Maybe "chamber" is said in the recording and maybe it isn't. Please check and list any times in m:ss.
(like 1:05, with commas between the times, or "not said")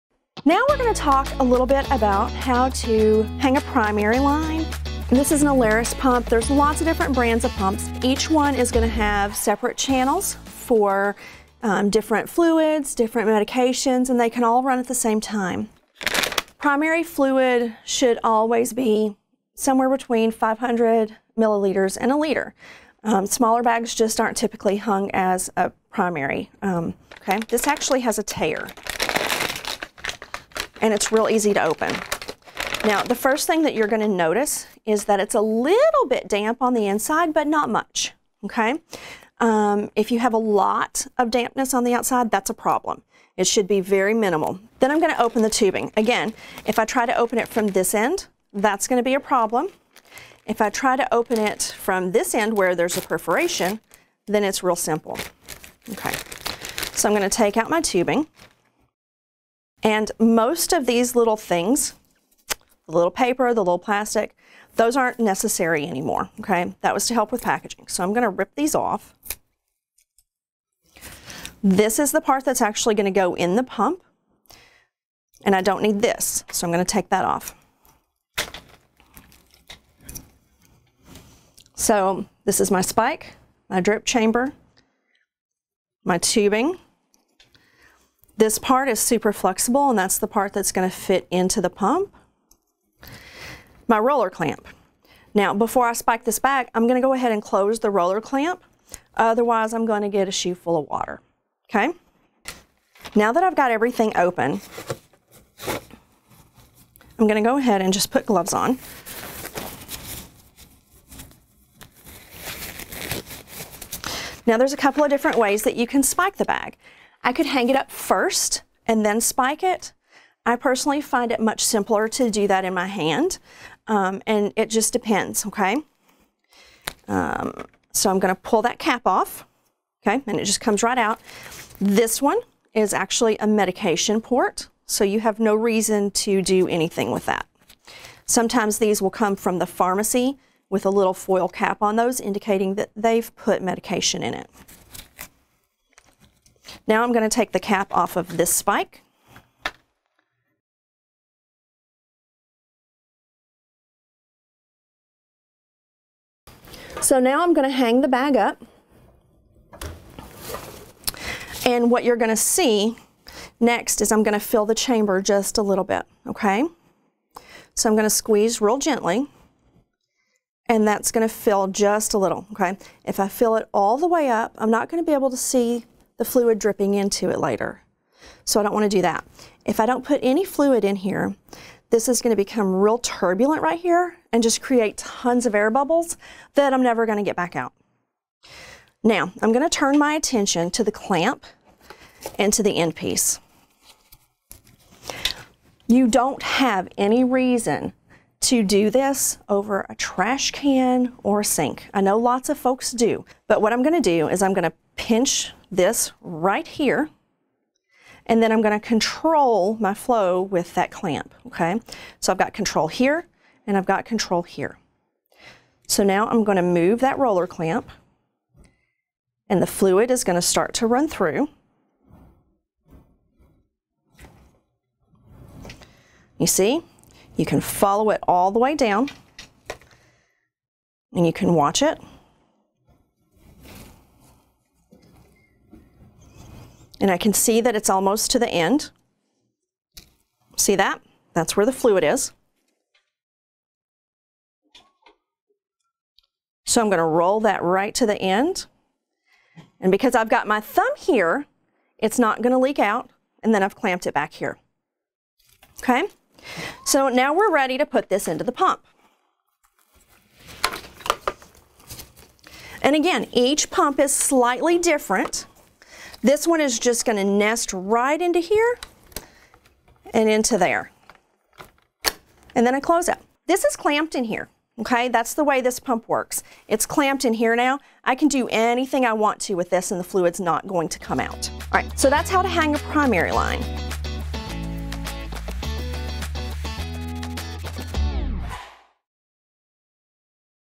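1:24, 2:44.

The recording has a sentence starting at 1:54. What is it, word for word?
Now there's a couple of different ways that you can spike the bag.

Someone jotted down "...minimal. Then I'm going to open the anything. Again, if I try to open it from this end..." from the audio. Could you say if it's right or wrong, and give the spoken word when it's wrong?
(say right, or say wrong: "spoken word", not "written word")
wrong: "tubing", not "anything".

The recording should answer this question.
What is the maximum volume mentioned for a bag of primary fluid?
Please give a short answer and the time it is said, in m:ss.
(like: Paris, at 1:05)
1 liter, at 0:22.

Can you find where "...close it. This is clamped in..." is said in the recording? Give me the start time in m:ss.
4:32.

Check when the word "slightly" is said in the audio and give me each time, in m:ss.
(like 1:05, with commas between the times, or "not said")
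4:24.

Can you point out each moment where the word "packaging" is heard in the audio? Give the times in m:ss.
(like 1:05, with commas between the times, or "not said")
1:07.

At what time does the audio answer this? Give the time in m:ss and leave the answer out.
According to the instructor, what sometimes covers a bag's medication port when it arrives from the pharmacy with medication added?
2:21.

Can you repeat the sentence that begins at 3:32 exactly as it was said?
So I've got control here, and I've got control here.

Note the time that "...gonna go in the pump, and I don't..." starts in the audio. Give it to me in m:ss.
1:12.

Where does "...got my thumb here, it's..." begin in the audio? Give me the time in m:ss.
4:10.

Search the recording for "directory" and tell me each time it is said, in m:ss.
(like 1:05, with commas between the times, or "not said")
not said.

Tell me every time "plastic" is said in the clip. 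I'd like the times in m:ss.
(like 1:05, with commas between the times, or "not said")
1:03.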